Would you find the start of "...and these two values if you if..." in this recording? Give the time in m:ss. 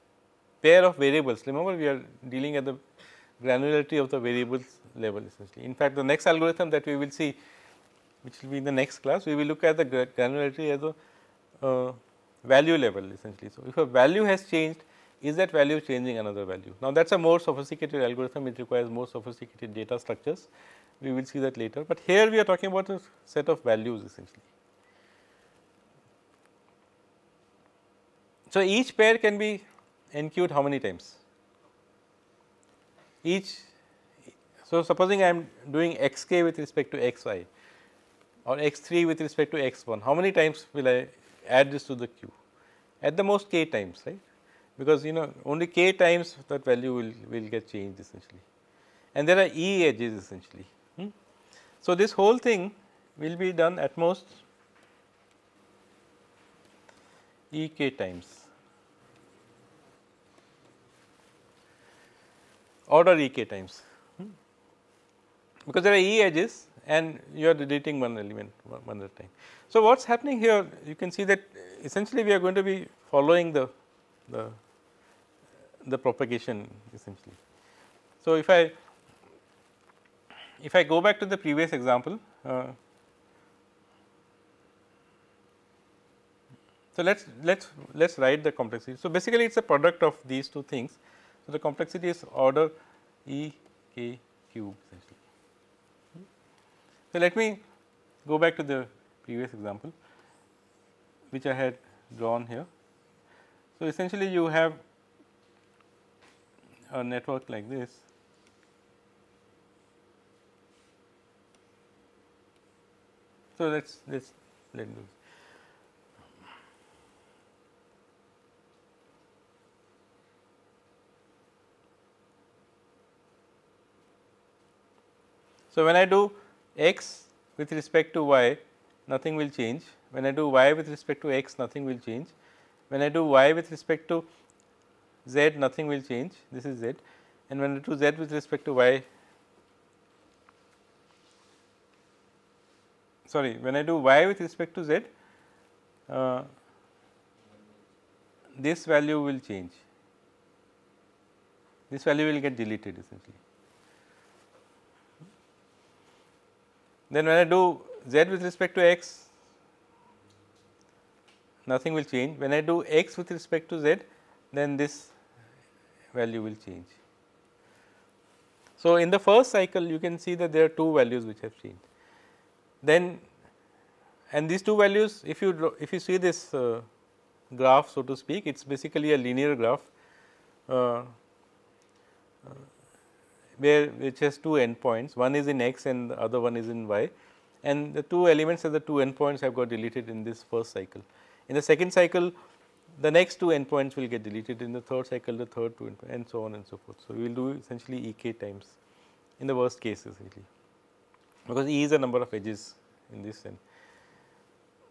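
2:54.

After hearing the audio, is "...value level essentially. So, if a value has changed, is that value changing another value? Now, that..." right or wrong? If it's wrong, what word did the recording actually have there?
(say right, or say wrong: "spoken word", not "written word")
right.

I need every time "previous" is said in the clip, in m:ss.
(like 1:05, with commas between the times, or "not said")
1:21, 1:39.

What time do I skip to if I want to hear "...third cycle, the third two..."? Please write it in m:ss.
3:14.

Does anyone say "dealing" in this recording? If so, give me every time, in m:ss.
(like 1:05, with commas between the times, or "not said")
0:02.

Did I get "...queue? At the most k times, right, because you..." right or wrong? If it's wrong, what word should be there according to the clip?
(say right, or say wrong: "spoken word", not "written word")
right.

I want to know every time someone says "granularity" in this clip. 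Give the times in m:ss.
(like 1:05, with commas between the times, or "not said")
0:03, 0:10.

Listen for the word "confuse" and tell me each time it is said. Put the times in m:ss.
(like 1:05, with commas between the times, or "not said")
not said.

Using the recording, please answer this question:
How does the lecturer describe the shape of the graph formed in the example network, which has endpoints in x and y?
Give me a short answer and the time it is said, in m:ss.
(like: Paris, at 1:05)
linear graph, at 2:59.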